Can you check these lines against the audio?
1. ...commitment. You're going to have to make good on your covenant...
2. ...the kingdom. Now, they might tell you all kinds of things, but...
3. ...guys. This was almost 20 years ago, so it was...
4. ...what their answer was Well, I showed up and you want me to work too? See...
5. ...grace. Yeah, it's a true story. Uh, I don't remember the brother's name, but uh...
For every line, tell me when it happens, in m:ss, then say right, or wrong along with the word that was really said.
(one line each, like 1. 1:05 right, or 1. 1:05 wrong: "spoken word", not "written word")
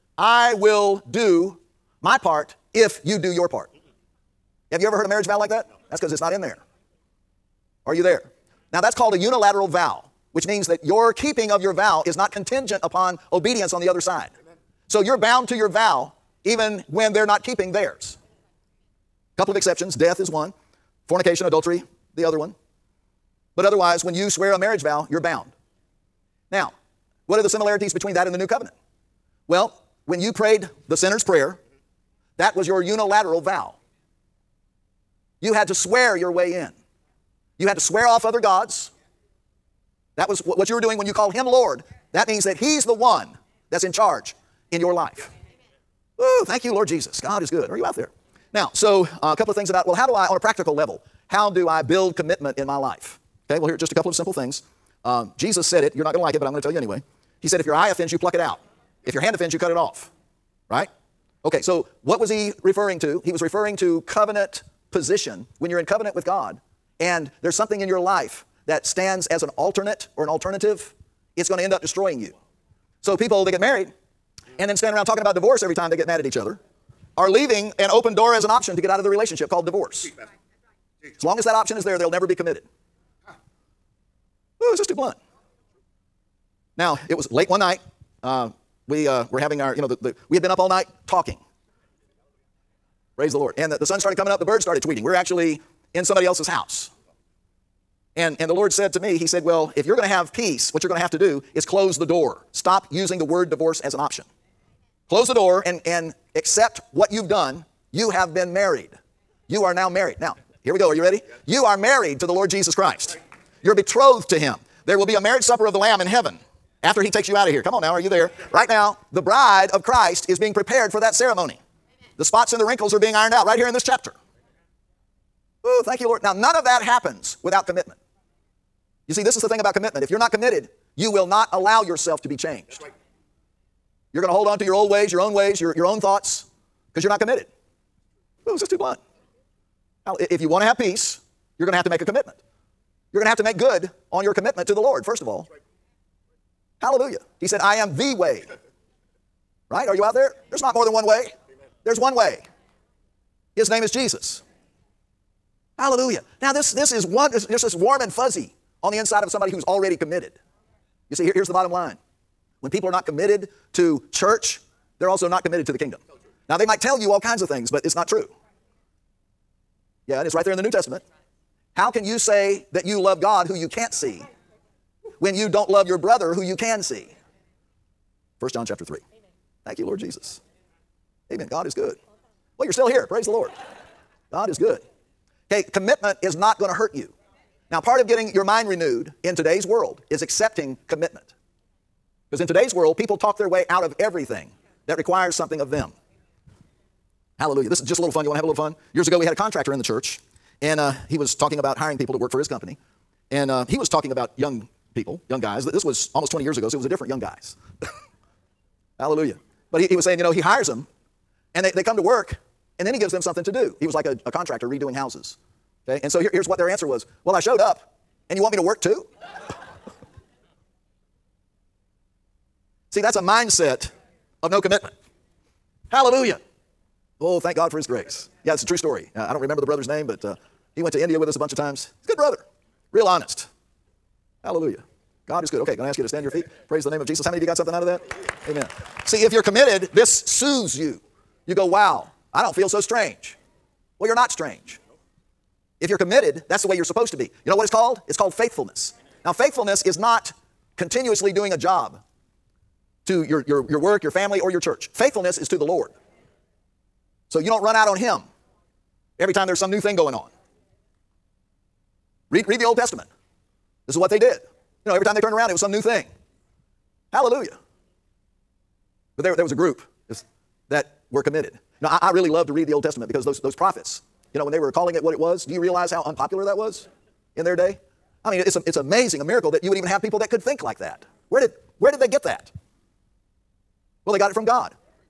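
1. 2:22 wrong: "commitment", not "covenant"
2. 2:45 right
3. 3:25 right
4. 3:36 right
5. 3:47 right.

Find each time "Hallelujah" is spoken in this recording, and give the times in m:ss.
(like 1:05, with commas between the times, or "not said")
2:26, 2:35, 3:17, 3:28, 3:45, 3:54, 4:27.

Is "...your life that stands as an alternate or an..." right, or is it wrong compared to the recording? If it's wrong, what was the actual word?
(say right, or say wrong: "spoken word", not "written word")
right.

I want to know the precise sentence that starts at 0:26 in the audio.
Now, what are the similarities between that and the new covenant?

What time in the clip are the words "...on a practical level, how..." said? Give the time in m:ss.
0:50.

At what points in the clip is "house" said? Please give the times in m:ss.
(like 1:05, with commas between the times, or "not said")
1:36, 3:34.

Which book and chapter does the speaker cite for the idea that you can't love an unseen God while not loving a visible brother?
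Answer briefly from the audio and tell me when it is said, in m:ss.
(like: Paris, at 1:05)
1 John chapter 3, at 2:58.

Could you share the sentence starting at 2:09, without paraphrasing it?
You see, this is the thing about commitment.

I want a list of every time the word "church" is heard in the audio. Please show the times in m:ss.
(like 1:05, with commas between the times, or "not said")
2:44, 3:19, 4:14.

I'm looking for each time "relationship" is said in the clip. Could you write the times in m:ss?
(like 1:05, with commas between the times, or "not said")
1:19.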